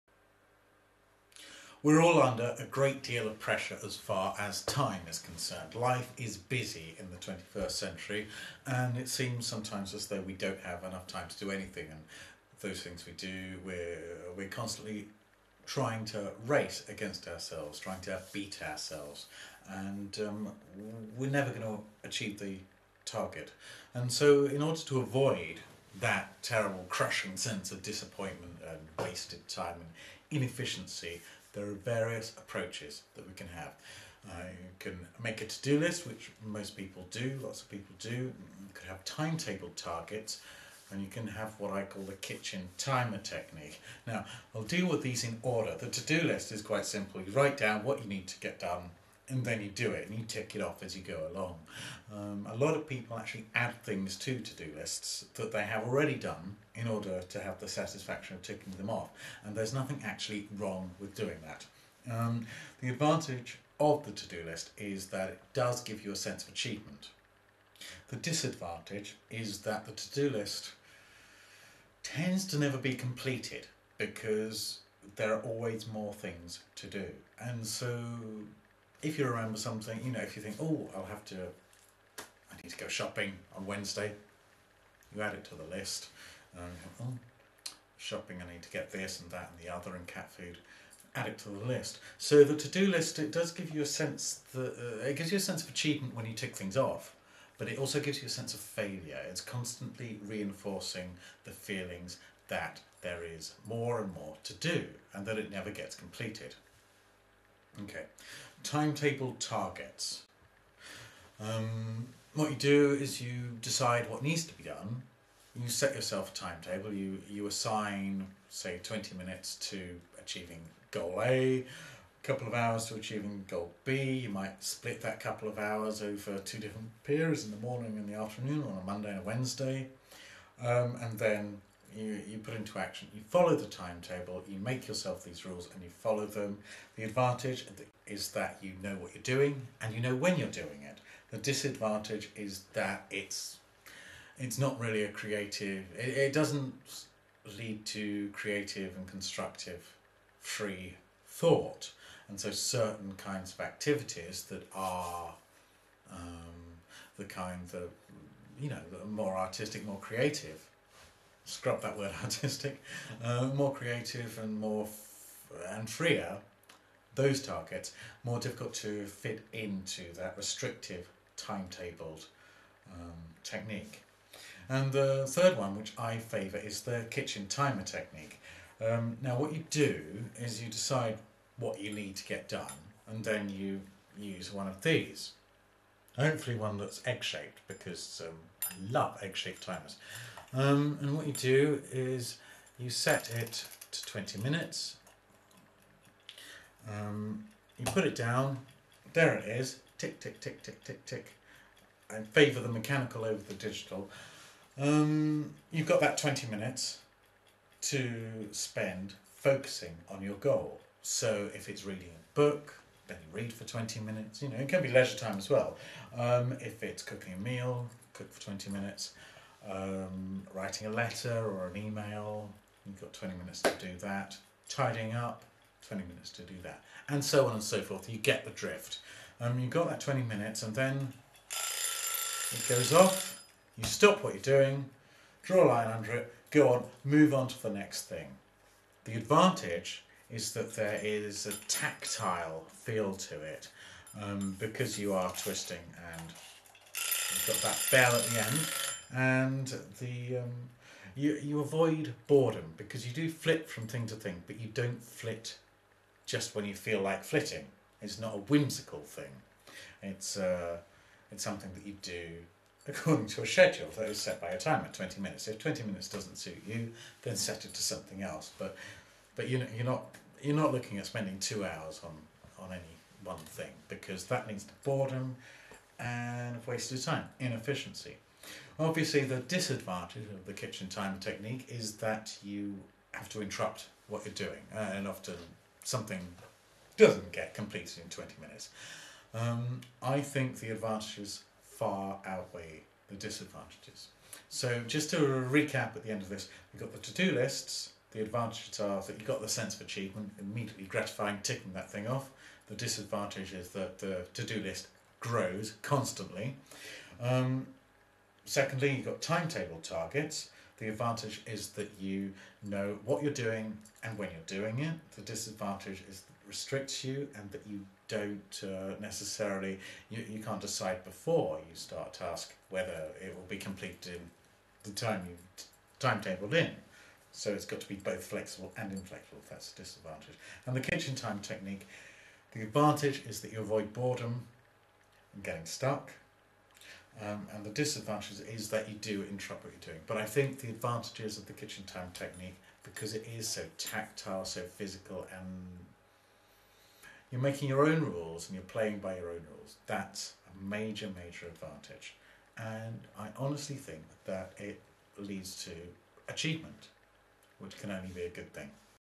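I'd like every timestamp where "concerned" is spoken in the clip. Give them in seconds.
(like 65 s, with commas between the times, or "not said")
5 s.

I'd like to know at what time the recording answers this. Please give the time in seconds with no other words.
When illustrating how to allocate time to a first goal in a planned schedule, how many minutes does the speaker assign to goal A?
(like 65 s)
118 s.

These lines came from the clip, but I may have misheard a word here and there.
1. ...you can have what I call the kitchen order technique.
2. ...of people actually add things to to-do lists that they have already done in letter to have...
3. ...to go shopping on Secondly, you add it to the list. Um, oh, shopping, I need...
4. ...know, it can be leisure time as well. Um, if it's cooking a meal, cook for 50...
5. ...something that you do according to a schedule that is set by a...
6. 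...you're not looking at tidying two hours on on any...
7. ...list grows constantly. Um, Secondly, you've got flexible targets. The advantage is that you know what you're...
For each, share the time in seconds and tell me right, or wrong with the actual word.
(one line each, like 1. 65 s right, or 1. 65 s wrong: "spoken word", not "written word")
1. 41 s wrong: "timer", not "order"
2. 52 s wrong: "order", not "letter"
3. 82 s wrong: "Wednesday", not "Secondly"
4. 214 s wrong: "20", not "50"
5. 261 s right
6. 270 s wrong: "spending", not "tidying"
7. 304 s wrong: "timetable", not "flexible".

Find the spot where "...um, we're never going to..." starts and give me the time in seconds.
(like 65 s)
20 s.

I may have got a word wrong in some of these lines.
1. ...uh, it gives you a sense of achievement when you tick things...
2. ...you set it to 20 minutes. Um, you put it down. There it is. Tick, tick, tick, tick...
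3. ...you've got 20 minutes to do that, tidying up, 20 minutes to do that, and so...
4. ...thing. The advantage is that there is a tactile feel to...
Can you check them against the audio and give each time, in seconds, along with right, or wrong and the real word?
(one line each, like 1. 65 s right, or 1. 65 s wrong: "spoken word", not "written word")
1. 94 s right
2. 192 s right
3. 222 s right
4. 238 s right.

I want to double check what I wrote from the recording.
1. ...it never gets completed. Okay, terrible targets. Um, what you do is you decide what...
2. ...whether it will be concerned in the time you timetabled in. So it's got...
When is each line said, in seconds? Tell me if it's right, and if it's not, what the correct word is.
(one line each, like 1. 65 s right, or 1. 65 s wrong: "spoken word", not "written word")
1. 105 s wrong: "timetable", not "terrible"
2. 322 s wrong: "completed", not "concerned".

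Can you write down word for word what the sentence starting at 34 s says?
Uh, you can make a to-do list, which most people do, lots of people do.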